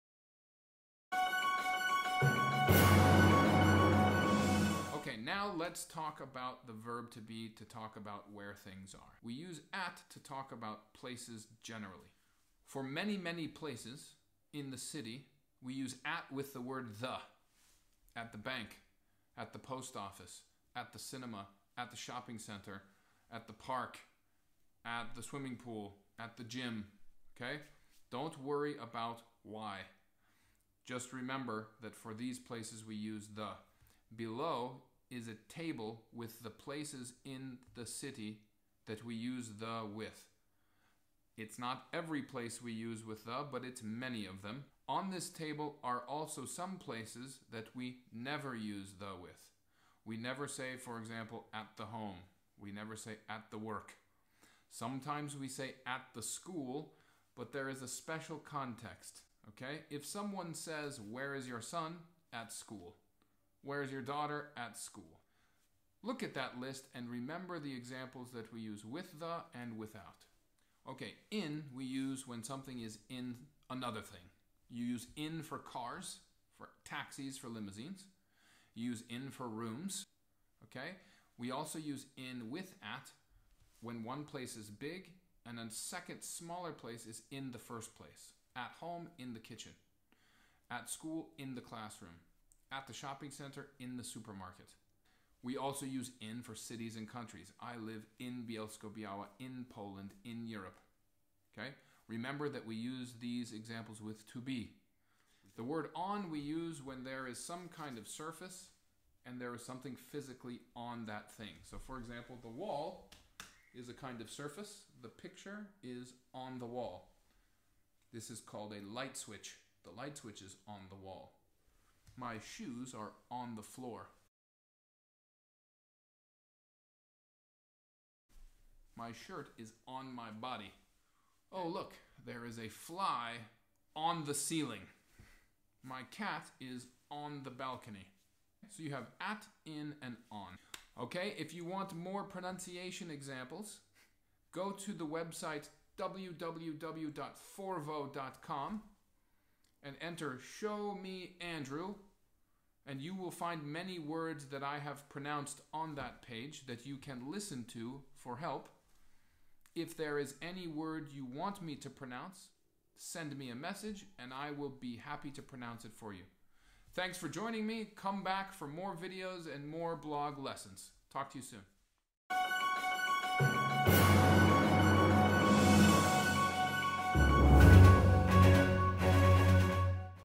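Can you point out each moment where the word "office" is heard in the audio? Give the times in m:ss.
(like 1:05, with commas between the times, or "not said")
0:19.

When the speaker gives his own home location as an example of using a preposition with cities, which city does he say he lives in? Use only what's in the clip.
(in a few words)
Bielsko-Biała.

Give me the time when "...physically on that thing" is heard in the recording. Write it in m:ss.
1:49.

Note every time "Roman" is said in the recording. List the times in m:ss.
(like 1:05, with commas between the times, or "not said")
not said.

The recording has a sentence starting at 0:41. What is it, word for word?
It's not every place we use with the, but it's many of them.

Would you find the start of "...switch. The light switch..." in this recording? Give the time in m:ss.
1:59.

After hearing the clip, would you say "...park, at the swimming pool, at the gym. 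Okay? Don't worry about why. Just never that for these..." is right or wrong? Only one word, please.
wrong.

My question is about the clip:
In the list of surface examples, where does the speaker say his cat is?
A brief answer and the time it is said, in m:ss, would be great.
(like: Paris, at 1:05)
on the balcony, at 2:17.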